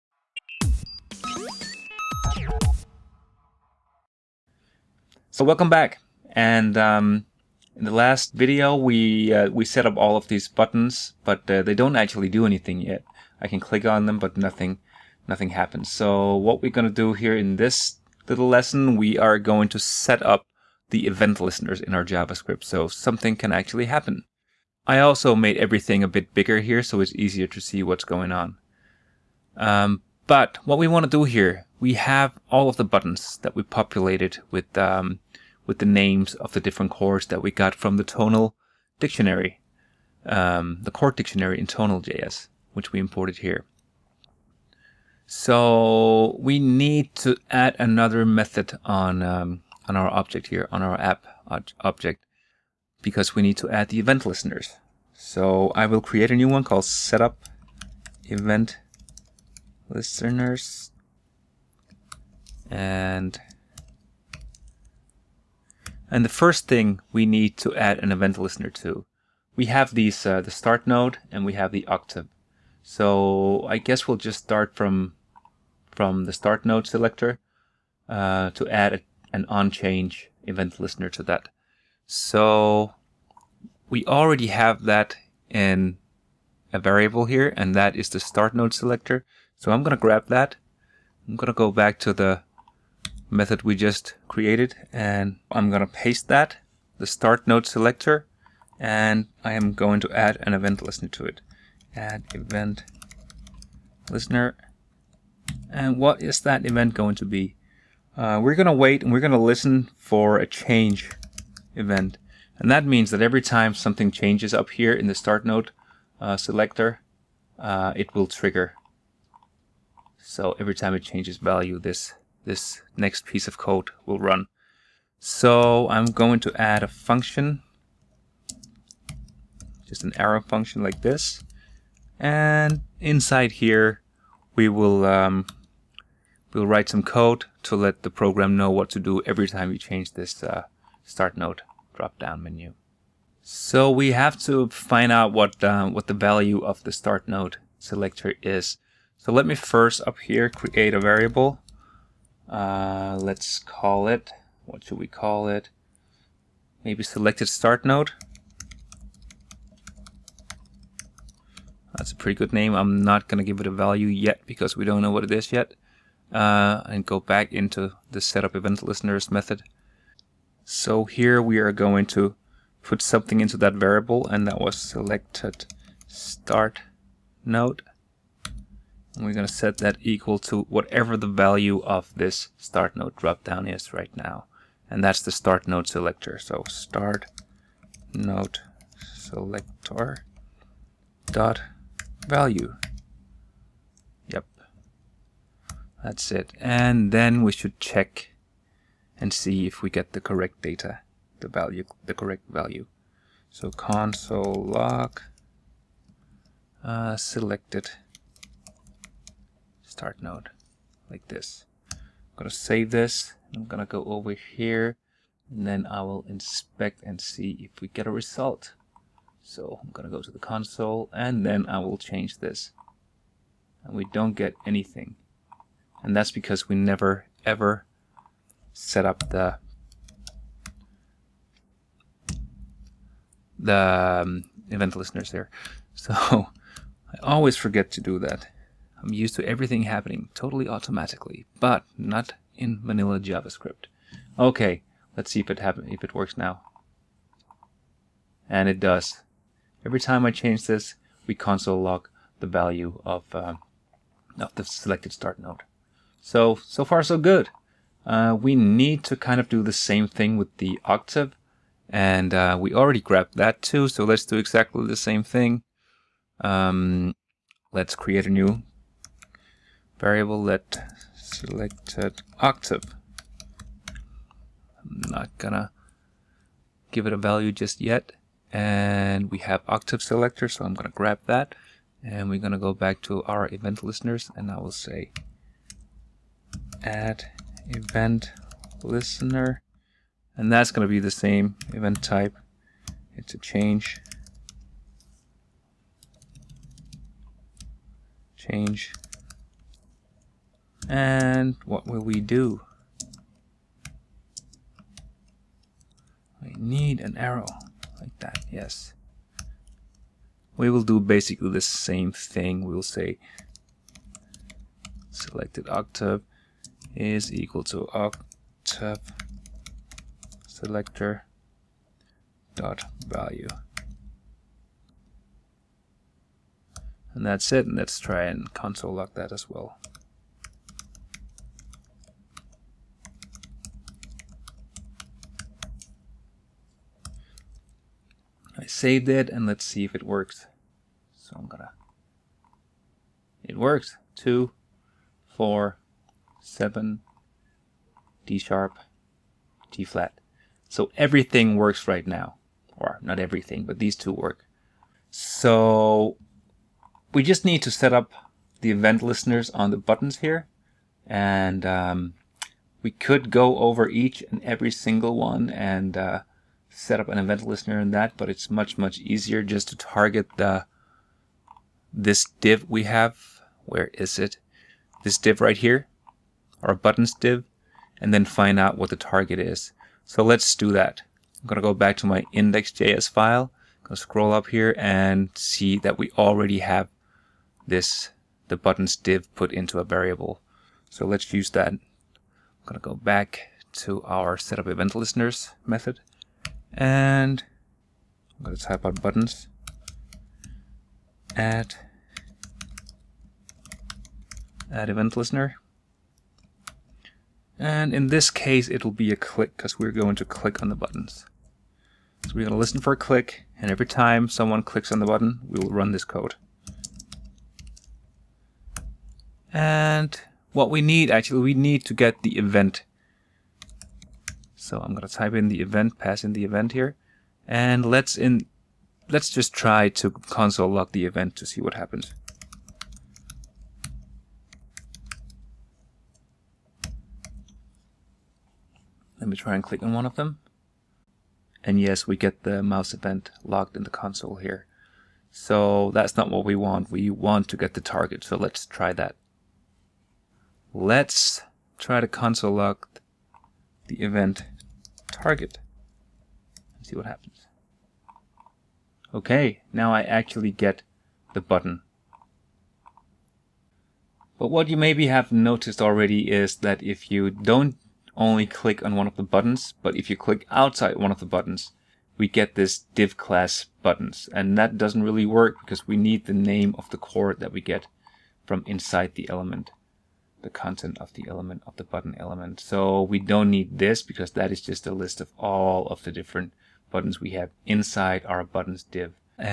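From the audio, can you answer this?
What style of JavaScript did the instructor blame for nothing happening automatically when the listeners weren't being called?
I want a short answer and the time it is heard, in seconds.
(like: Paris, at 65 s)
vanilla JavaScript, at 242 s.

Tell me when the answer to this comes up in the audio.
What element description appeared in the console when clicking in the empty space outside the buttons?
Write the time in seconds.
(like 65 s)
472 s.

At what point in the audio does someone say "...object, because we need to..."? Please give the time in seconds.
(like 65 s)
51 s.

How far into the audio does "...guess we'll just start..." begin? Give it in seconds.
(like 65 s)
73 s.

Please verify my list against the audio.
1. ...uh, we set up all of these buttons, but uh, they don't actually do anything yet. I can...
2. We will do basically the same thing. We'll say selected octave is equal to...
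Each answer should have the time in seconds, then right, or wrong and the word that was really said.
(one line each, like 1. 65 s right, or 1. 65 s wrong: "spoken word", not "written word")
1. 9 s right
2. 310 s right.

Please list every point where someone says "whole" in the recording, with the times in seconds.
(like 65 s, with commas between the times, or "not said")
not said.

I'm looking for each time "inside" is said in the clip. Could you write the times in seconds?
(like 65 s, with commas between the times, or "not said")
132 s, 478 s, 487 s.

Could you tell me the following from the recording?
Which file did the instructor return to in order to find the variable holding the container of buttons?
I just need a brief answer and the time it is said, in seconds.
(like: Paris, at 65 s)
index.js, at 382 s.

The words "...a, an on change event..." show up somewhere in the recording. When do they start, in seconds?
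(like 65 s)
78 s.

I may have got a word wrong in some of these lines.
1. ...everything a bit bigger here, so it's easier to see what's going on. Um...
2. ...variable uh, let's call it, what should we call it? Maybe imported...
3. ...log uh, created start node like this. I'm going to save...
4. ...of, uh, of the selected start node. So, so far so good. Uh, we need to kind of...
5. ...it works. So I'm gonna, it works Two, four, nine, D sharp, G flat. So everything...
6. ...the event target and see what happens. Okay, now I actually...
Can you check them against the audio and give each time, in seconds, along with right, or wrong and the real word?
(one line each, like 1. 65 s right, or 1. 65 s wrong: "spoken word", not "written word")
1. 25 s right
2. 151 s wrong: "selected", not "imported"
3. 204 s wrong: "selected", not "created"
4. 253 s right
5. 339 s wrong: "seven", not "nine"
6. 453 s right.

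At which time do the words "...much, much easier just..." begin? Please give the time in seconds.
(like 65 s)
368 s.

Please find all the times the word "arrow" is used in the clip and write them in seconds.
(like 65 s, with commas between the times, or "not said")
130 s, 307 s.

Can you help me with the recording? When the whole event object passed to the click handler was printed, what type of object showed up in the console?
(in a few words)
mouse event.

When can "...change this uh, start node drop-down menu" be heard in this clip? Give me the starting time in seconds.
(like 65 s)
139 s.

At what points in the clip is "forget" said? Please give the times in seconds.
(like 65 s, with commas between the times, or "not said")
237 s.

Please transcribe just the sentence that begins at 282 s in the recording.
And we're gonna go back to our event listeners and I will say add event listener.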